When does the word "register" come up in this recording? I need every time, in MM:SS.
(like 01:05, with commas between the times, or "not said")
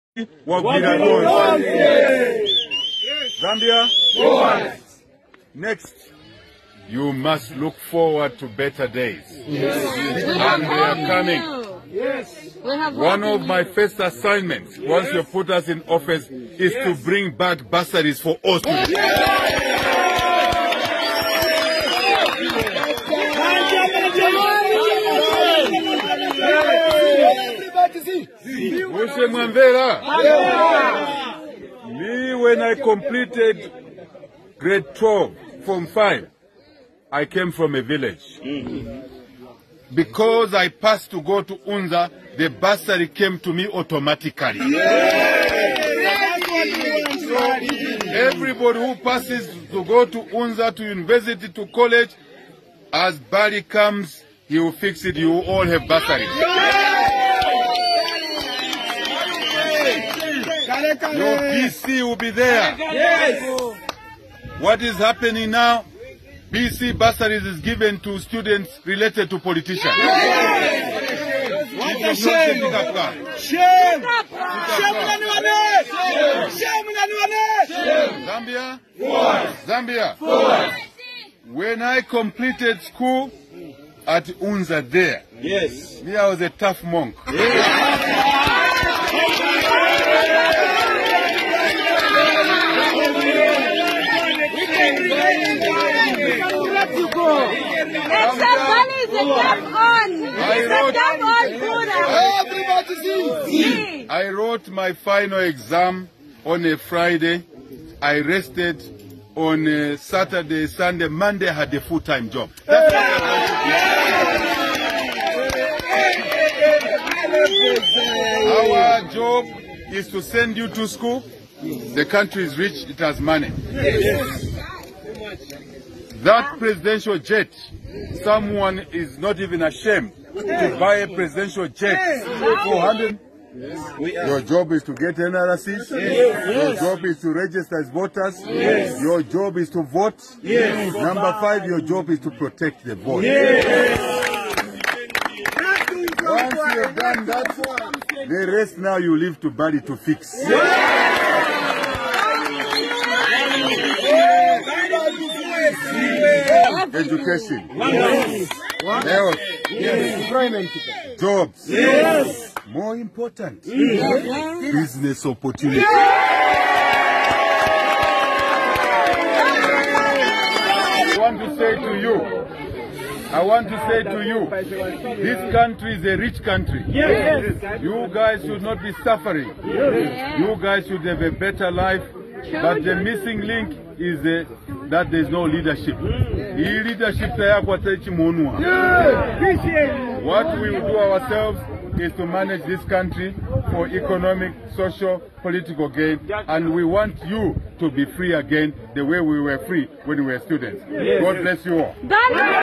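02:17.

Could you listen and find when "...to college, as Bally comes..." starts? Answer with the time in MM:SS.
00:51.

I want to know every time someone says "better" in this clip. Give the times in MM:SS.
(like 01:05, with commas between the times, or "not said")
00:08, 03:01.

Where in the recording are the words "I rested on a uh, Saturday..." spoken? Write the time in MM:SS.
01:48.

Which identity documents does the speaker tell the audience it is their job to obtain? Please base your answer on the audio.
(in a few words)
NRCs.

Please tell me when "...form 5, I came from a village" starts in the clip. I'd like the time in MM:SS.
00:35.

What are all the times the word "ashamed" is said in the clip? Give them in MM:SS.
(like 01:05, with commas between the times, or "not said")
02:09.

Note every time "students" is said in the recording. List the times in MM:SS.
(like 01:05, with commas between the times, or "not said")
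00:18, 01:08, 03:20.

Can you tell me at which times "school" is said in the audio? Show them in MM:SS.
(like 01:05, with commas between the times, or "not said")
01:22, 02:00.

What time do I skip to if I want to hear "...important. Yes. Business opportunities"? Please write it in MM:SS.
02:42.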